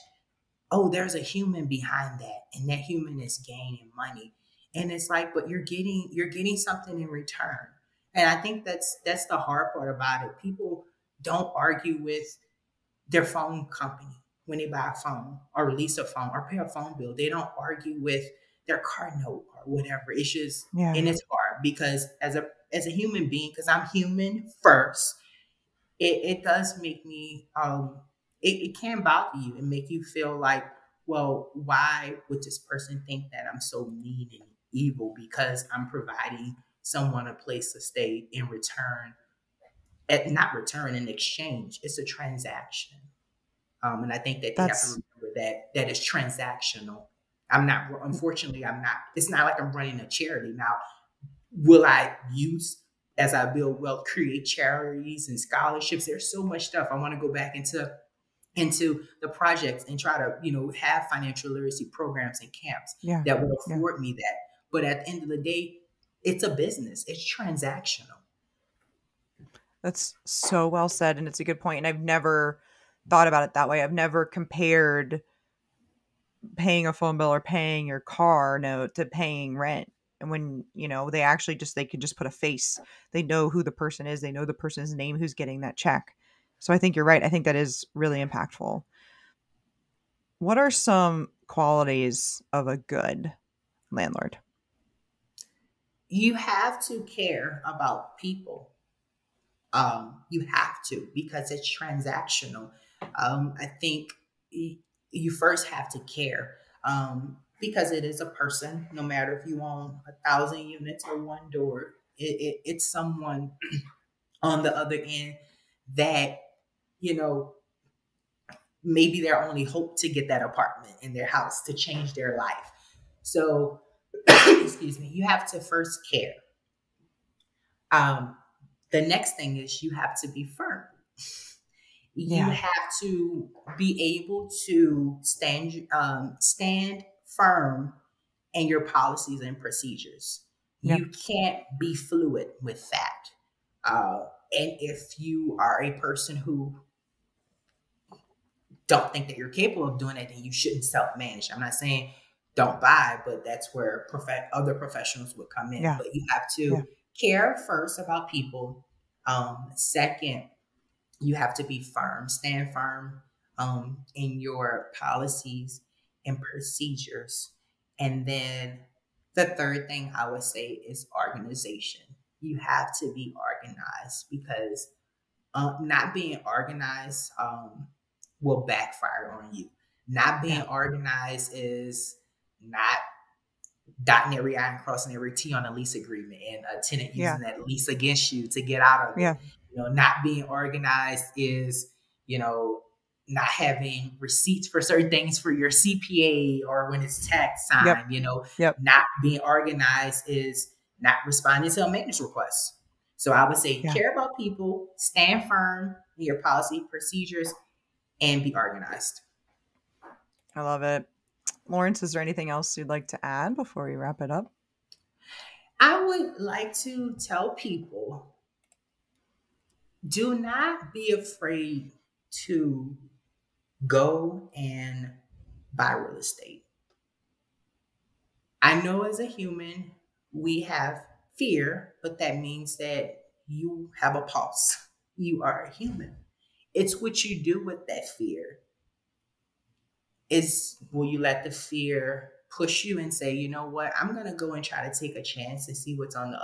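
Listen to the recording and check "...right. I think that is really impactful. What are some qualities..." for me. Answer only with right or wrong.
right.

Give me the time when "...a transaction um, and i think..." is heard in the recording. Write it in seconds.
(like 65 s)
41 s.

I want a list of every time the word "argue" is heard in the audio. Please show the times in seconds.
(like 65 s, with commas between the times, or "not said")
11 s, 17 s.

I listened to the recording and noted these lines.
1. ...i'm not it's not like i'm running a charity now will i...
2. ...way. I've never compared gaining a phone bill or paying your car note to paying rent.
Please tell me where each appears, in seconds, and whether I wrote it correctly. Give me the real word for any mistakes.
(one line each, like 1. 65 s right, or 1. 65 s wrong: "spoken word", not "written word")
1. 48 s right
2. 73 s wrong: "paying", not "gaining".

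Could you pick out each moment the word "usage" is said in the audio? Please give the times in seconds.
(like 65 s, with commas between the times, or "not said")
not said.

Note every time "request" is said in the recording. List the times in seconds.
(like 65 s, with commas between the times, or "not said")
202 s.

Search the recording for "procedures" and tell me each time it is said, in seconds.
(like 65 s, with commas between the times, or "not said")
139 s, 166 s, 206 s.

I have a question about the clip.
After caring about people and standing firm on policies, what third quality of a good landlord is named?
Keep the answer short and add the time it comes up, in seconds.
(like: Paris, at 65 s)
organization, at 171 s.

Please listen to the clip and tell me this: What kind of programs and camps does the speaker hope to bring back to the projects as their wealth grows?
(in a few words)
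financial literacy.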